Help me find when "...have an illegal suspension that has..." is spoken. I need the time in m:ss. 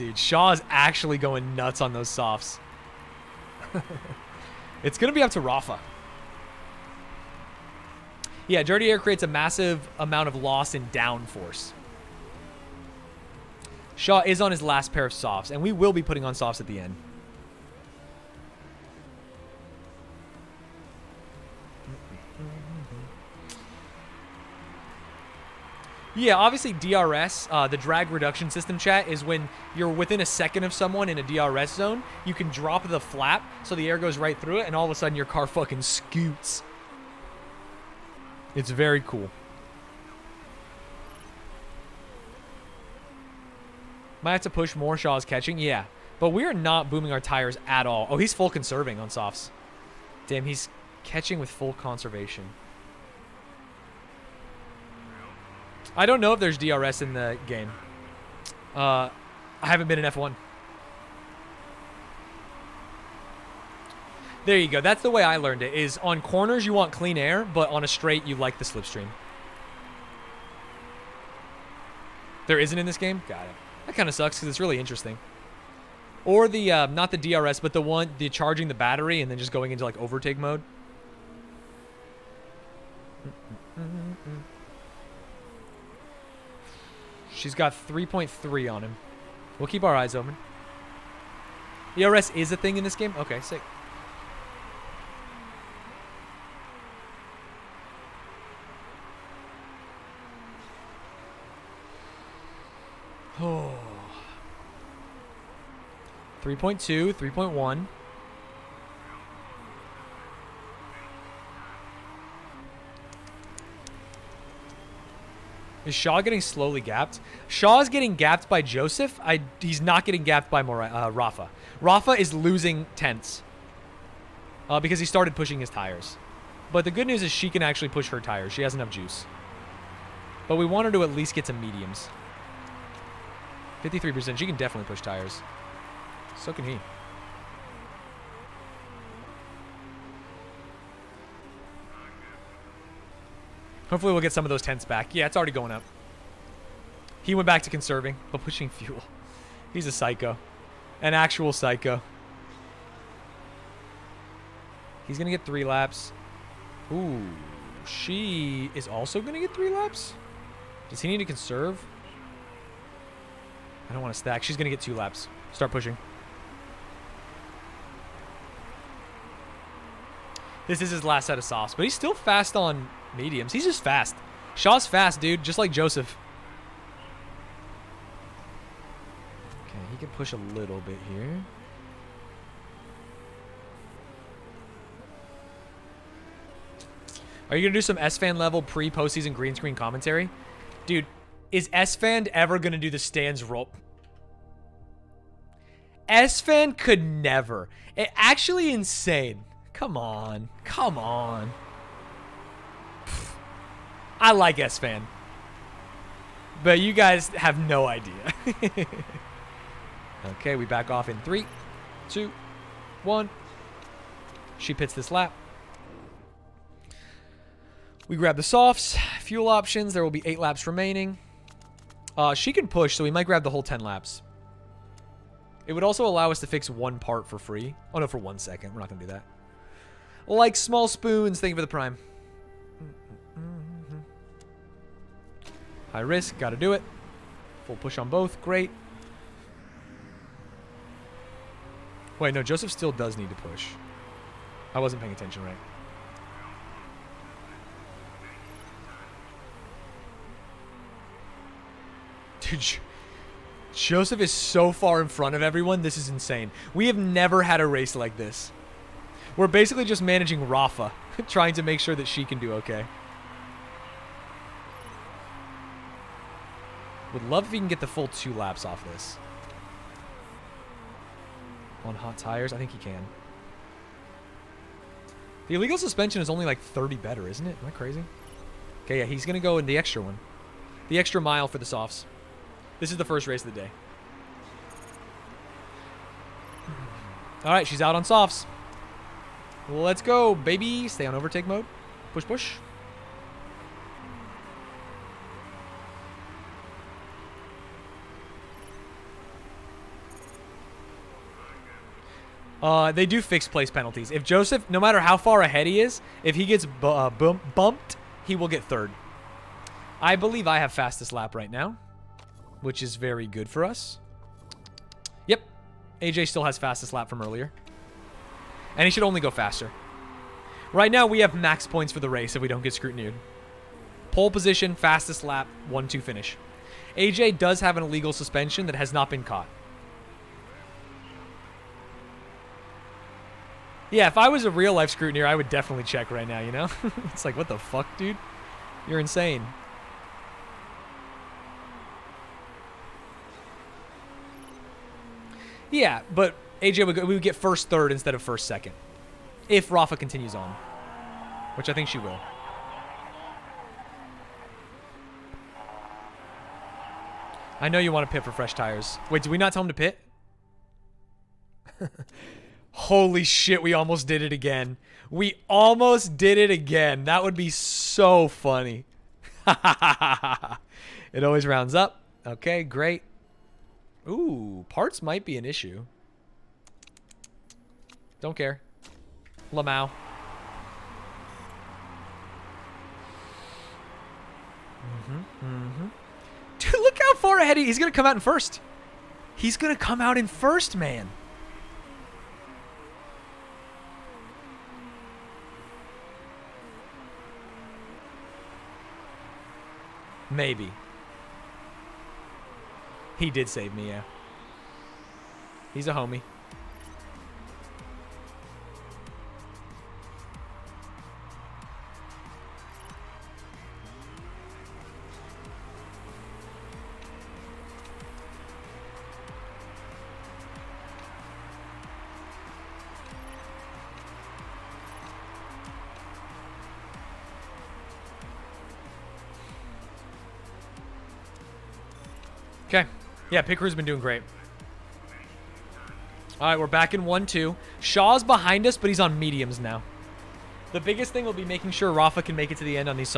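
5:27.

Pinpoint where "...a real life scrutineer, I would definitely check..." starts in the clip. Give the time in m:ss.
5:34.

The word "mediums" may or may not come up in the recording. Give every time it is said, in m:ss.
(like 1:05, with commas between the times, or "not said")
2:11, 2:53, 7:19.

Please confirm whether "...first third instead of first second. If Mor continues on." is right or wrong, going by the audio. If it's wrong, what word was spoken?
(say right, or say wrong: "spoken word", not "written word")
wrong: "Rafa", not "Mor".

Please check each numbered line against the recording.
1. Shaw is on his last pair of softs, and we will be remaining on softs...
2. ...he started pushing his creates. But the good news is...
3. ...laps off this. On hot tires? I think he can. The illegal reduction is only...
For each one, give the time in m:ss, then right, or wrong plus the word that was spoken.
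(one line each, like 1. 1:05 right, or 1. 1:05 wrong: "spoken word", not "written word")
1. 0:13 wrong: "putting", not "remaining"
2. 2:04 wrong: "tires", not "creates"
3. 4:28 wrong: "suspension", not "reduction".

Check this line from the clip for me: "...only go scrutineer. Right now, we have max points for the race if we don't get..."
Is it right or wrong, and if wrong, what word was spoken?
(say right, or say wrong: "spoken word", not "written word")
wrong: "faster", not "scrutineer".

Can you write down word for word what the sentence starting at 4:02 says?
Wait, no, Joseph still does need to push.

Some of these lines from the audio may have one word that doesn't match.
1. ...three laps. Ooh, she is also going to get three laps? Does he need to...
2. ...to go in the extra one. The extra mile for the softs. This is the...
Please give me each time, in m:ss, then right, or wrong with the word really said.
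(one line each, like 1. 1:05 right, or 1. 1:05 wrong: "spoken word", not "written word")
1. 2:35 right
2. 4:39 right.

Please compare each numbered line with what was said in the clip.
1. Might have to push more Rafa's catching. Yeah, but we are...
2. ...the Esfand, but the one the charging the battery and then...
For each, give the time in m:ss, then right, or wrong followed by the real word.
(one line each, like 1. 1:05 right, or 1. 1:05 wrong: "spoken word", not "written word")
1. 0:44 wrong: "Shaw", not "Rafa"
2. 1:17 wrong: "DRS", not "Esfand".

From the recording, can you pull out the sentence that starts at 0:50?
Damn, he's catching with full conservation.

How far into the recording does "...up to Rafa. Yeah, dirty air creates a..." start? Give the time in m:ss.
0:05.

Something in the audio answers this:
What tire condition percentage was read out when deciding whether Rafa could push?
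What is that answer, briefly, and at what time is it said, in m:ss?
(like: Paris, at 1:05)
53%, at 2:13.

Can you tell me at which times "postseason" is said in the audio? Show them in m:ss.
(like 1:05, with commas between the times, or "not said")
3:08.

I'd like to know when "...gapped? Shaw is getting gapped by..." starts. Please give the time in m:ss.
1:56.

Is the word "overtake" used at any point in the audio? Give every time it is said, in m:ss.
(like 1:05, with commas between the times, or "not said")
1:19, 4:51.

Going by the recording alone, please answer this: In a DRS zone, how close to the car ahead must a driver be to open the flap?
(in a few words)
a second.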